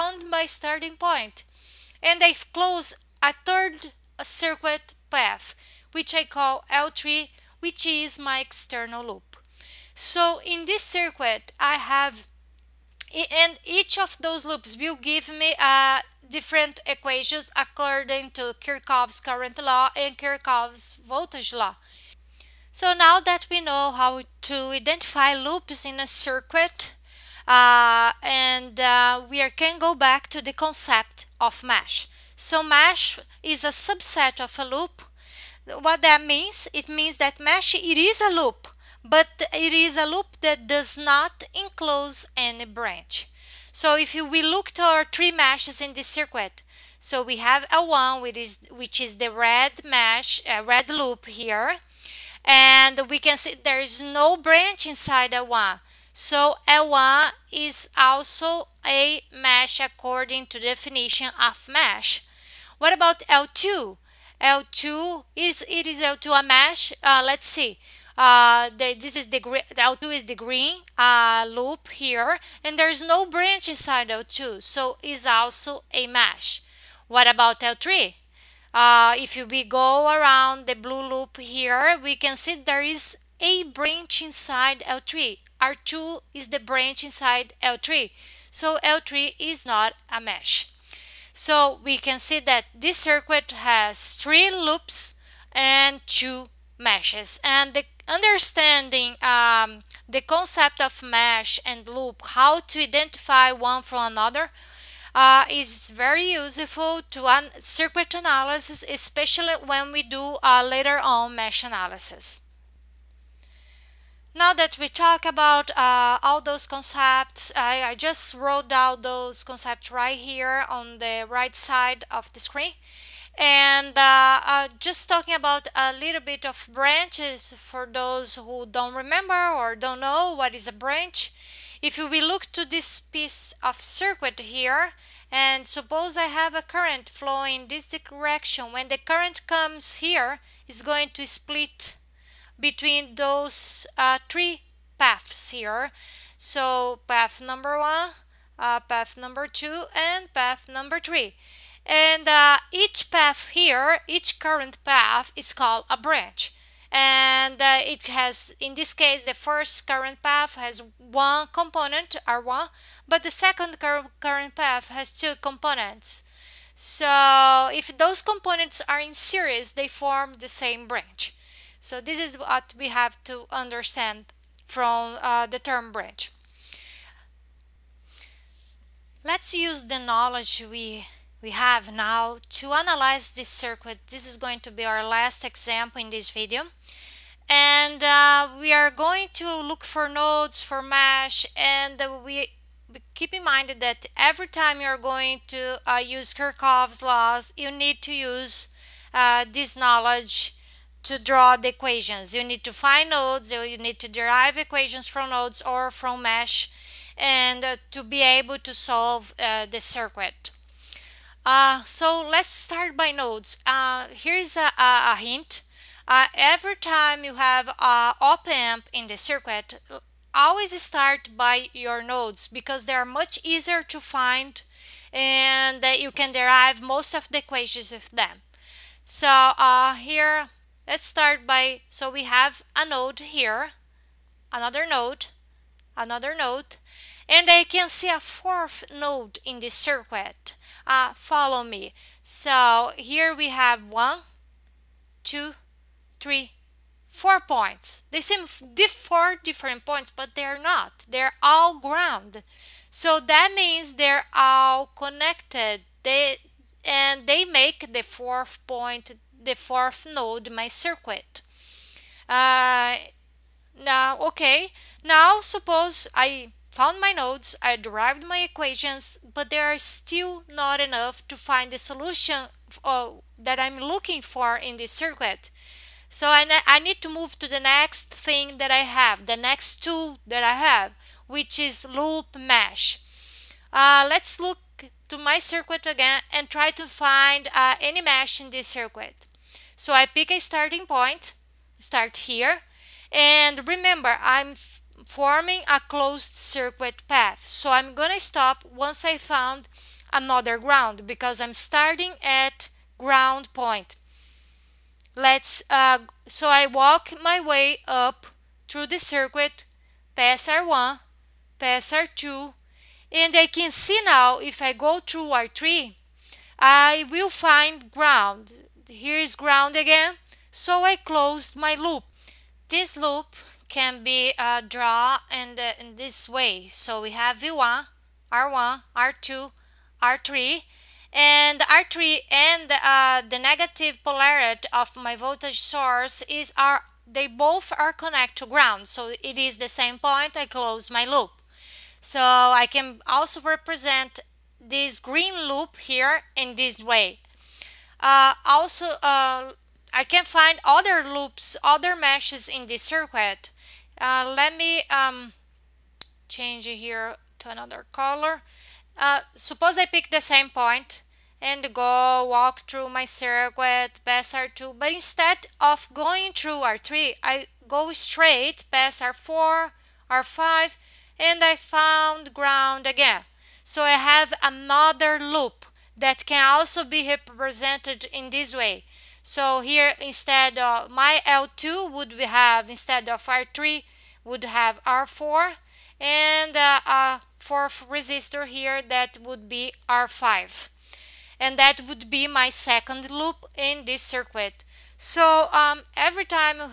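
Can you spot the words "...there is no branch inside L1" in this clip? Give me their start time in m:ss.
0:53.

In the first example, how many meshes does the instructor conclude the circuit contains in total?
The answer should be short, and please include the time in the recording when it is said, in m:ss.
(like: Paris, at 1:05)
2, at 1:36.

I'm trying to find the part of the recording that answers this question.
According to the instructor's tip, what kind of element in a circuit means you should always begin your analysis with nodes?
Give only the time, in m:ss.
3:38.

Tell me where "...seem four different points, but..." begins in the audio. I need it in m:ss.
4:08.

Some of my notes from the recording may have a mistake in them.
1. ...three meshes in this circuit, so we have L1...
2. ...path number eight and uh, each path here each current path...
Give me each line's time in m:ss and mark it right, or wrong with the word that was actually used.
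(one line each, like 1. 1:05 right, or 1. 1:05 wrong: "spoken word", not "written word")
1. 0:45 right
2. 2:30 wrong: "three", not "eight".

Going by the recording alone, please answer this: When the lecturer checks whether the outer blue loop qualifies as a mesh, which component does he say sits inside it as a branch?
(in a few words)
R2.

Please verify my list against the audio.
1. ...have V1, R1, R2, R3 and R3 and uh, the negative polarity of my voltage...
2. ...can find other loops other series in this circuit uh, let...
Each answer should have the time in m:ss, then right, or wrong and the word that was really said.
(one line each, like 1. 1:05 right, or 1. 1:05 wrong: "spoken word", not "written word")
1. 5:27 right
2. 5:50 wrong: "meshes", not "series".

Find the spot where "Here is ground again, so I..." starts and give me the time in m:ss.
5:18.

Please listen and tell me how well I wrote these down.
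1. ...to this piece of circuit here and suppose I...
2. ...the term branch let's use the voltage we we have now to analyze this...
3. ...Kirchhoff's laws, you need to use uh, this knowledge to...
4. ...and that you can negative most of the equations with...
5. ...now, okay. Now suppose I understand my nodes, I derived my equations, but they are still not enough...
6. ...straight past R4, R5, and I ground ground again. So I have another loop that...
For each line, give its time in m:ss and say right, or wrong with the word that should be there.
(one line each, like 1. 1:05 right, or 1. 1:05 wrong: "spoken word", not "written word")
1. 2:12 right
2. 2:55 wrong: "knowledge", not "voltage"
3. 3:16 right
4. 3:45 wrong: "derive", not "negative"
5. 4:23 wrong: "found", not "understand"
6. 6:07 wrong: "found", not "ground".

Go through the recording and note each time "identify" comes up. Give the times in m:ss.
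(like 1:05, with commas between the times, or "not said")
0:24, 1:42.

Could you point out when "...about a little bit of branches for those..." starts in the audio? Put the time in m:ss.
2:05.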